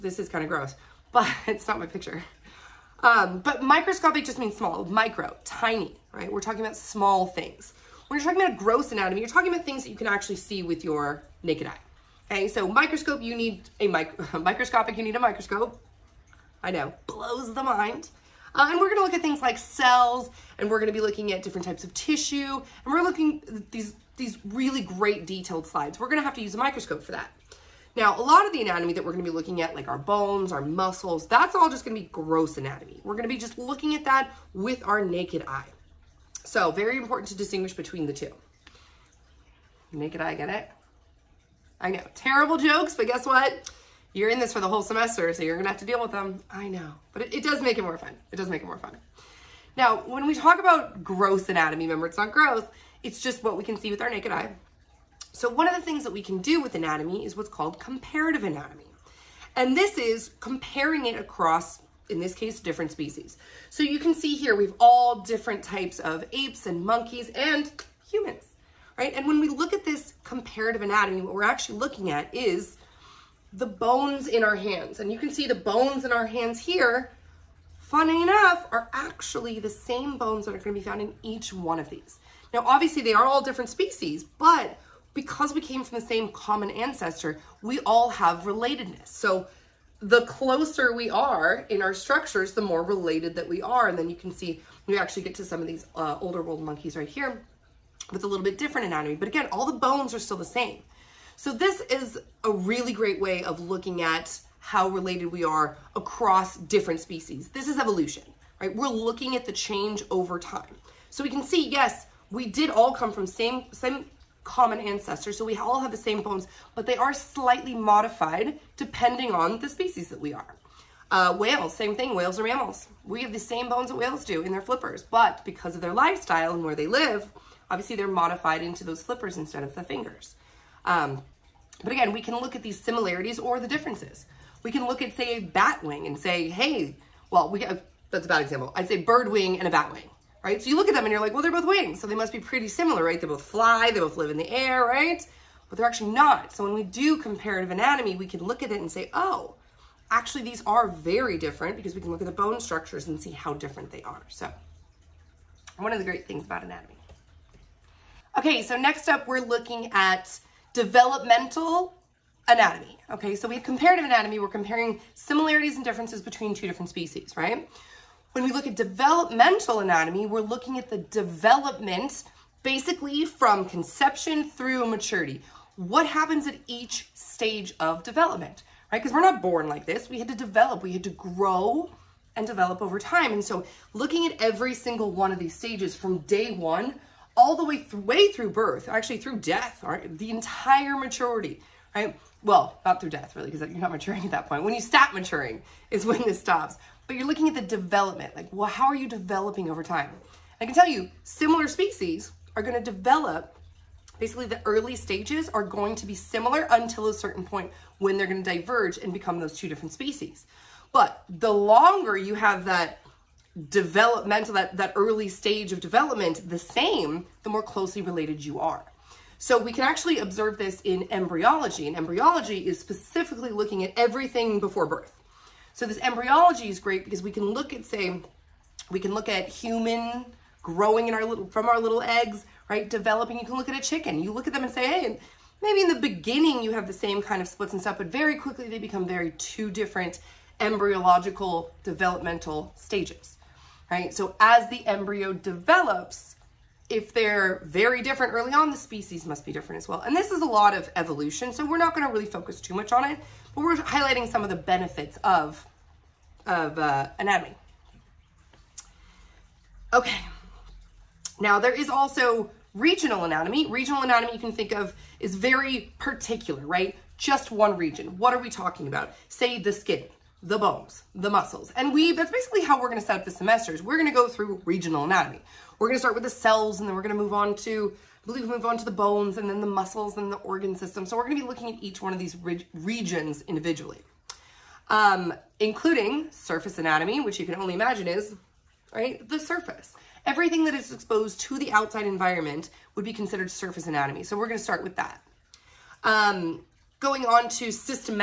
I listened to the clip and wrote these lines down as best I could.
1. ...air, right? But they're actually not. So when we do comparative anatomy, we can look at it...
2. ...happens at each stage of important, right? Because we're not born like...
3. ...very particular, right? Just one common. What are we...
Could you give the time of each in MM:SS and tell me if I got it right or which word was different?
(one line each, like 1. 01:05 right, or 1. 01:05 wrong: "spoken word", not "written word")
1. 02:24 right
2. 02:56 wrong: "development", not "important"
3. 04:25 wrong: "region", not "common".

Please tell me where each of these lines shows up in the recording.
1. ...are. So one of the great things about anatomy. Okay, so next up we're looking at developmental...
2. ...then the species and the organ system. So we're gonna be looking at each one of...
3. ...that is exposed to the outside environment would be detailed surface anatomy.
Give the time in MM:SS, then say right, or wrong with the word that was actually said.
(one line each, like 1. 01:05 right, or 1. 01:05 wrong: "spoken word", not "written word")
1. 02:34 right
2. 04:39 wrong: "muscles", not "species"
3. 04:50 wrong: "considered", not "detailed".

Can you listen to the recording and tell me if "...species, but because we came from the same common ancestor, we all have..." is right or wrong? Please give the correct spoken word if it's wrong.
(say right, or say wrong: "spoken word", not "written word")
right.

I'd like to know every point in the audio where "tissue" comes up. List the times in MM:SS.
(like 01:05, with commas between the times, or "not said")
00:21.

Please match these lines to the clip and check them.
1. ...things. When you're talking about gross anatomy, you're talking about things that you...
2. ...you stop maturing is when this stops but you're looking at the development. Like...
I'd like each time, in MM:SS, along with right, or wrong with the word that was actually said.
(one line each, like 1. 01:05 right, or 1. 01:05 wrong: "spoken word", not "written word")
1. 00:07 right
2. 03:14 right.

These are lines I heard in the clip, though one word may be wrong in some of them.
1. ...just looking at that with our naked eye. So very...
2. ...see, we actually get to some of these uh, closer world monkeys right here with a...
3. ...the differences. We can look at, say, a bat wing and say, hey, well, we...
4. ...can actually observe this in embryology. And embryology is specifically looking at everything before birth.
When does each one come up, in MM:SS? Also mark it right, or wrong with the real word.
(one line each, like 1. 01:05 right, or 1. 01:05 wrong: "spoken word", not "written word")
1. 00:33 right
2. 01:34 wrong: "older", not "closer"
3. 02:13 right
4. 03:39 right.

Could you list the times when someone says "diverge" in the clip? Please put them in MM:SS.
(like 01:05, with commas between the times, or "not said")
03:28.